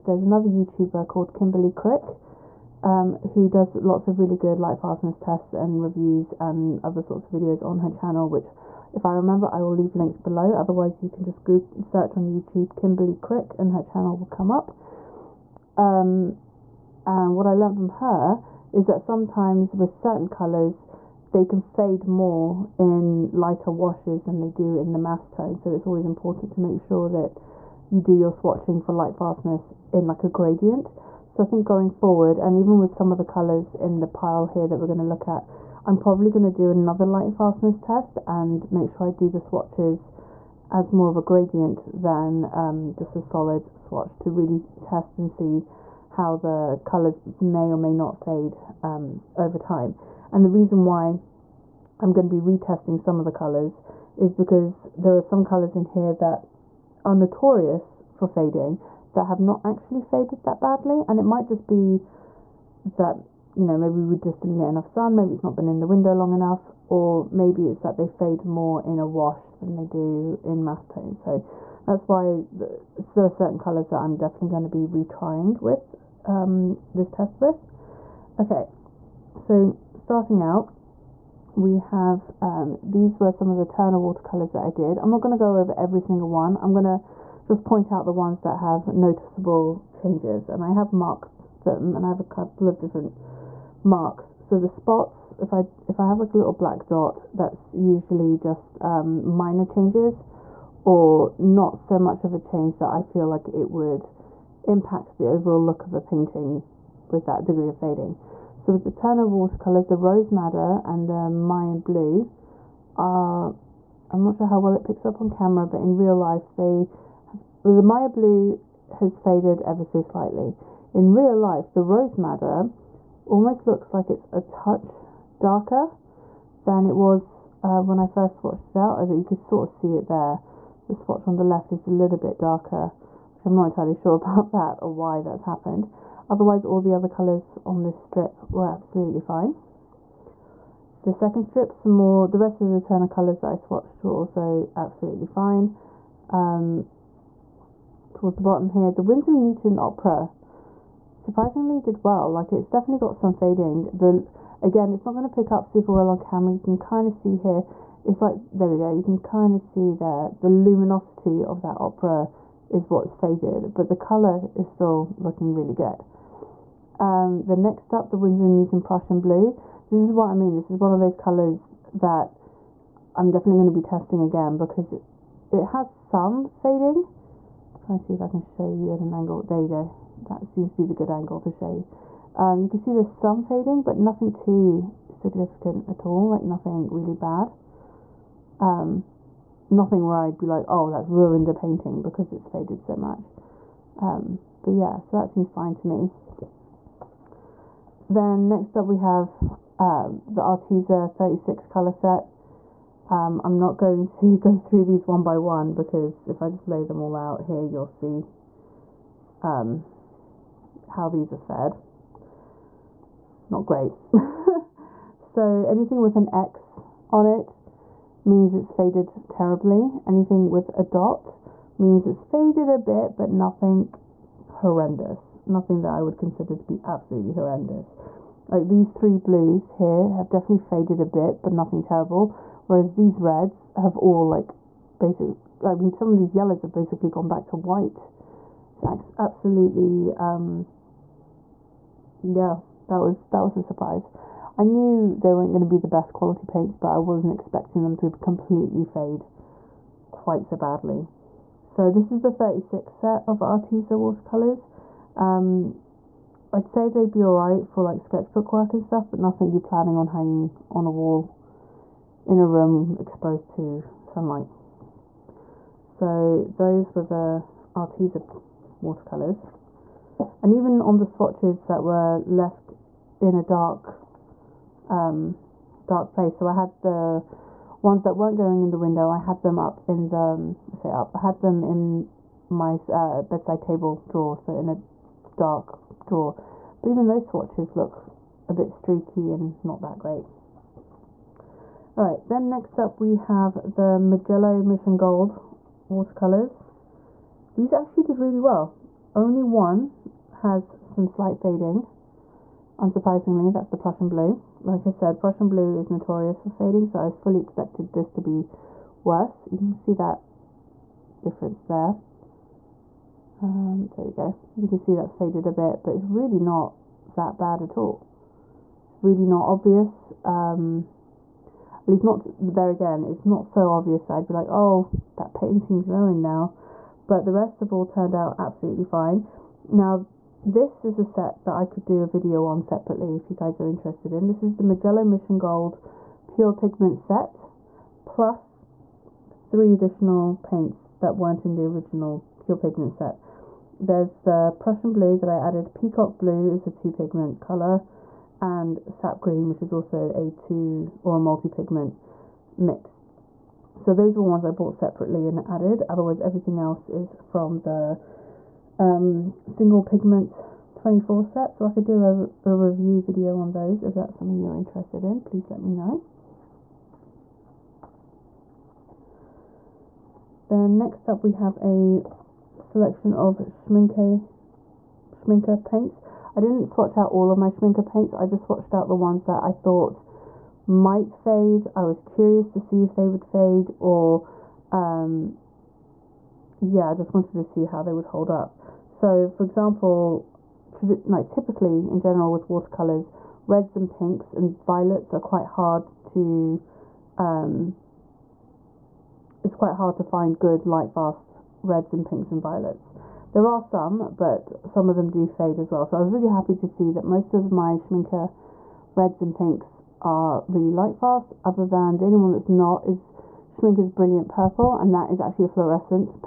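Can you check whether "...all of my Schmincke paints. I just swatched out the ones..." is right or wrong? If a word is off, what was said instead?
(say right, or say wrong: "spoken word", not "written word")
right.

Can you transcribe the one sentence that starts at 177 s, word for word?
I'm trying to see if I can show you at an angle.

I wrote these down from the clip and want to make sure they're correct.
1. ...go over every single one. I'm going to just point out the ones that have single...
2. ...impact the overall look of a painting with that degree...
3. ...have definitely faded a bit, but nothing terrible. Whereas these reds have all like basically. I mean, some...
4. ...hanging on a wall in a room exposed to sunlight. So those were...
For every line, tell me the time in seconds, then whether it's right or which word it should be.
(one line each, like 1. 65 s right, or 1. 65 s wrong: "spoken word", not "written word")
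1. 85 s wrong: "noticeable", not "single"
2. 104 s right
3. 230 s right
4. 260 s right.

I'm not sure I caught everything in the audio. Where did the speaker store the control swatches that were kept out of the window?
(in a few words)
bedside table drawer.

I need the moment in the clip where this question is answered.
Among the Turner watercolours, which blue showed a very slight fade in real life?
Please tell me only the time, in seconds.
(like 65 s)
117 s.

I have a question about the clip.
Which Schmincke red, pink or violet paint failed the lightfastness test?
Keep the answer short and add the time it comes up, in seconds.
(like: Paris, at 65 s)
Brilliant Purple, at 413 s.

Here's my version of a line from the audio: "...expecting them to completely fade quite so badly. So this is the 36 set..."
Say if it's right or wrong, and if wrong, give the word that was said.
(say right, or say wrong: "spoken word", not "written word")
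right.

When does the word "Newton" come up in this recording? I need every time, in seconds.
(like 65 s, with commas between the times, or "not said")
149 s, 168 s.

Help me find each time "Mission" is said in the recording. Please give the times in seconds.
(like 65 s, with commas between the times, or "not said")
294 s, 335 s.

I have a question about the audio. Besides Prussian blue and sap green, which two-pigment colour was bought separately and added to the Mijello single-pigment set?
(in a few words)
Peacock blue.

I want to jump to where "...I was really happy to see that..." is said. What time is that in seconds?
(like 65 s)
405 s.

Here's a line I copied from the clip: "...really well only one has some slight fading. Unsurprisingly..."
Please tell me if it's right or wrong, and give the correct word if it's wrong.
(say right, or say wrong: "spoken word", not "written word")
right.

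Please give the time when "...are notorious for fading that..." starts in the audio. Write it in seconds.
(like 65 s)
57 s.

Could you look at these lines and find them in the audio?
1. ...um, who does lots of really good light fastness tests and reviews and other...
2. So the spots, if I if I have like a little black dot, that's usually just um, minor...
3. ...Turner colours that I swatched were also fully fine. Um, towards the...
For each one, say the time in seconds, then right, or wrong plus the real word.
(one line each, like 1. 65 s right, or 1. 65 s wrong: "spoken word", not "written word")
1. 2 s right
2. 94 s right
3. 142 s wrong: "absolutely", not "fully".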